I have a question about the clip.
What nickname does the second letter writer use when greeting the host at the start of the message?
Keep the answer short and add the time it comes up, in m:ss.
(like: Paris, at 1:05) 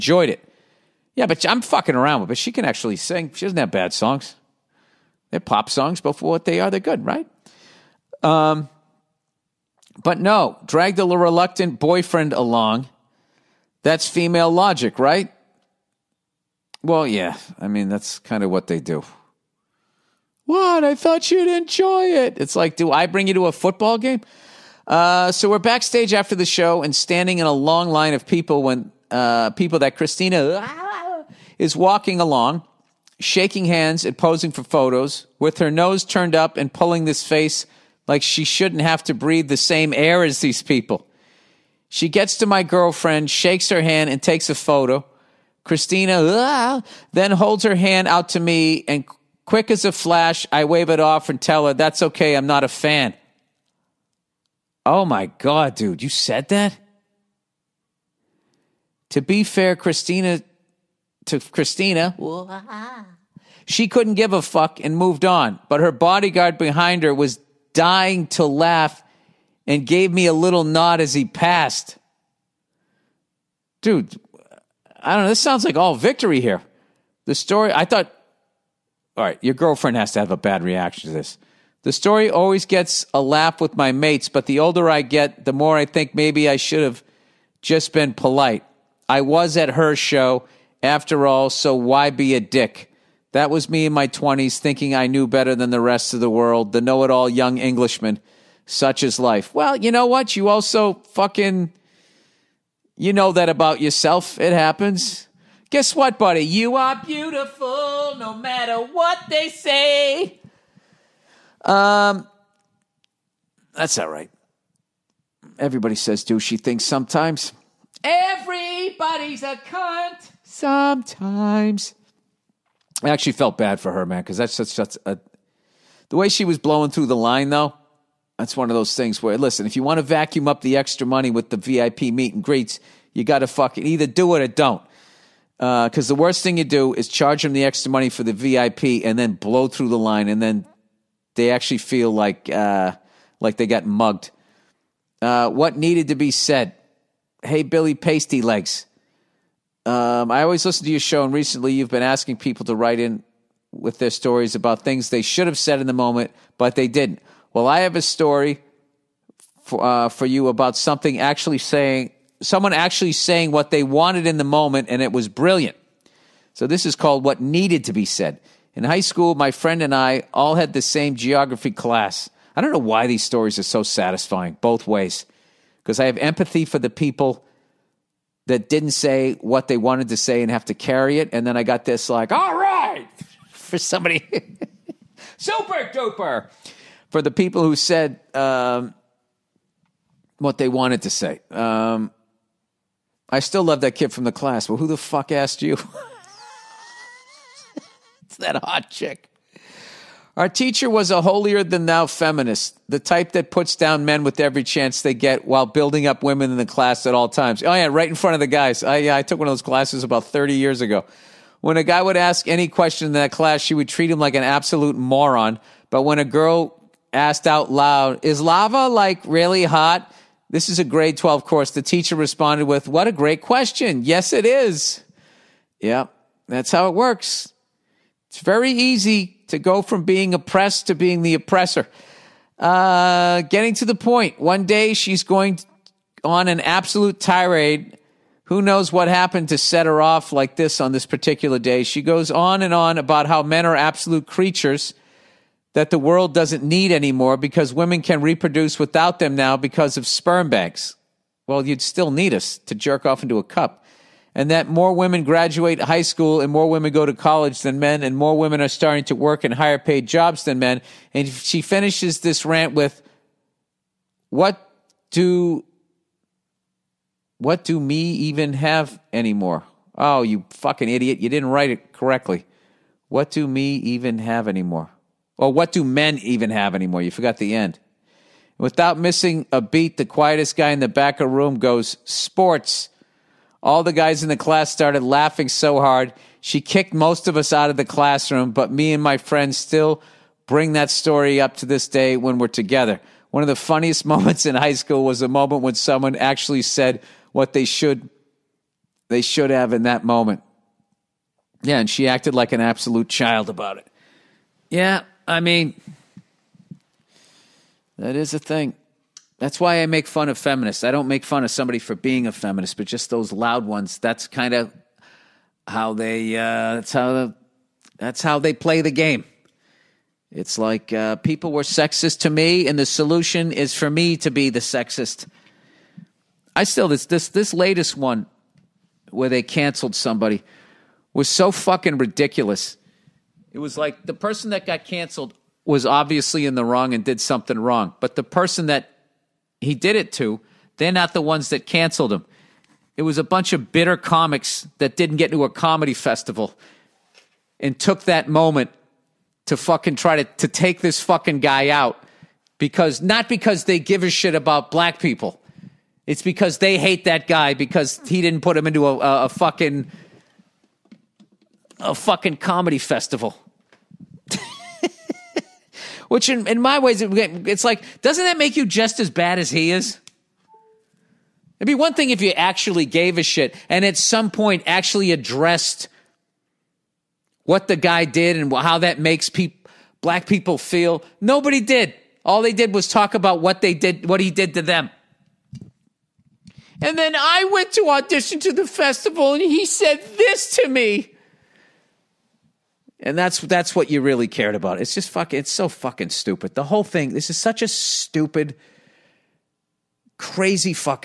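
Billy Pasty Legs, at 2:27.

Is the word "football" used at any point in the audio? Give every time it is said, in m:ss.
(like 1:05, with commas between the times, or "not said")
0:23.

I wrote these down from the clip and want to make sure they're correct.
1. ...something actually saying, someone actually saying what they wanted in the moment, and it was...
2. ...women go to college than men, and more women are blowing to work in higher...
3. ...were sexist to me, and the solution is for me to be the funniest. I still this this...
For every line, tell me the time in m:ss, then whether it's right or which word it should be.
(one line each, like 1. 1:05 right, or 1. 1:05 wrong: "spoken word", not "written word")
1. 2:40 right
2. 4:16 wrong: "starting", not "blowing"
3. 5:21 wrong: "sexist", not "funniest".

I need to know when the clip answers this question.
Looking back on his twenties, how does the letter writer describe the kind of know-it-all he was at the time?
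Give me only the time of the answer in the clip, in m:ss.
1:37.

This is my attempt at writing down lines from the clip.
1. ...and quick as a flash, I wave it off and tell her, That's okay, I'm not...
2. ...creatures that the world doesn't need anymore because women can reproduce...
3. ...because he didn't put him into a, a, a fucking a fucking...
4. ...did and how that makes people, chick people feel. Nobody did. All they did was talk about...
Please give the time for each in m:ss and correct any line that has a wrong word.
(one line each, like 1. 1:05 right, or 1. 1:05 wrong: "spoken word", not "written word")
1. 0:48 right
2. 4:04 right
3. 5:57 right
4. 6:18 wrong: "black", not "chick".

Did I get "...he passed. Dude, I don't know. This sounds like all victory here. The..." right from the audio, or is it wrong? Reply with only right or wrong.
right.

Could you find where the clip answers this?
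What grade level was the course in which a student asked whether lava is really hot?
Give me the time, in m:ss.
3:40.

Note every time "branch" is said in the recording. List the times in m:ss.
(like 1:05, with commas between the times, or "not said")
not said.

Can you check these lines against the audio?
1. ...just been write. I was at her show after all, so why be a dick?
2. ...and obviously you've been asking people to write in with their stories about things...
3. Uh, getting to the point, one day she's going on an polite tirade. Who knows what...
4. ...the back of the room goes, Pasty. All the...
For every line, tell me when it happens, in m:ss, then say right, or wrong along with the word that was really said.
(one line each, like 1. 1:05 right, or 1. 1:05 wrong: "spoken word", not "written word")
1. 1:27 wrong: "polite", not "write"
2. 2:31 wrong: "recently", not "obviously"
3. 3:52 wrong: "absolute", not "polite"
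4. 4:40 wrong: "Sports", not "Pasty".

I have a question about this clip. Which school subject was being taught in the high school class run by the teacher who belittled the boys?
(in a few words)
geography.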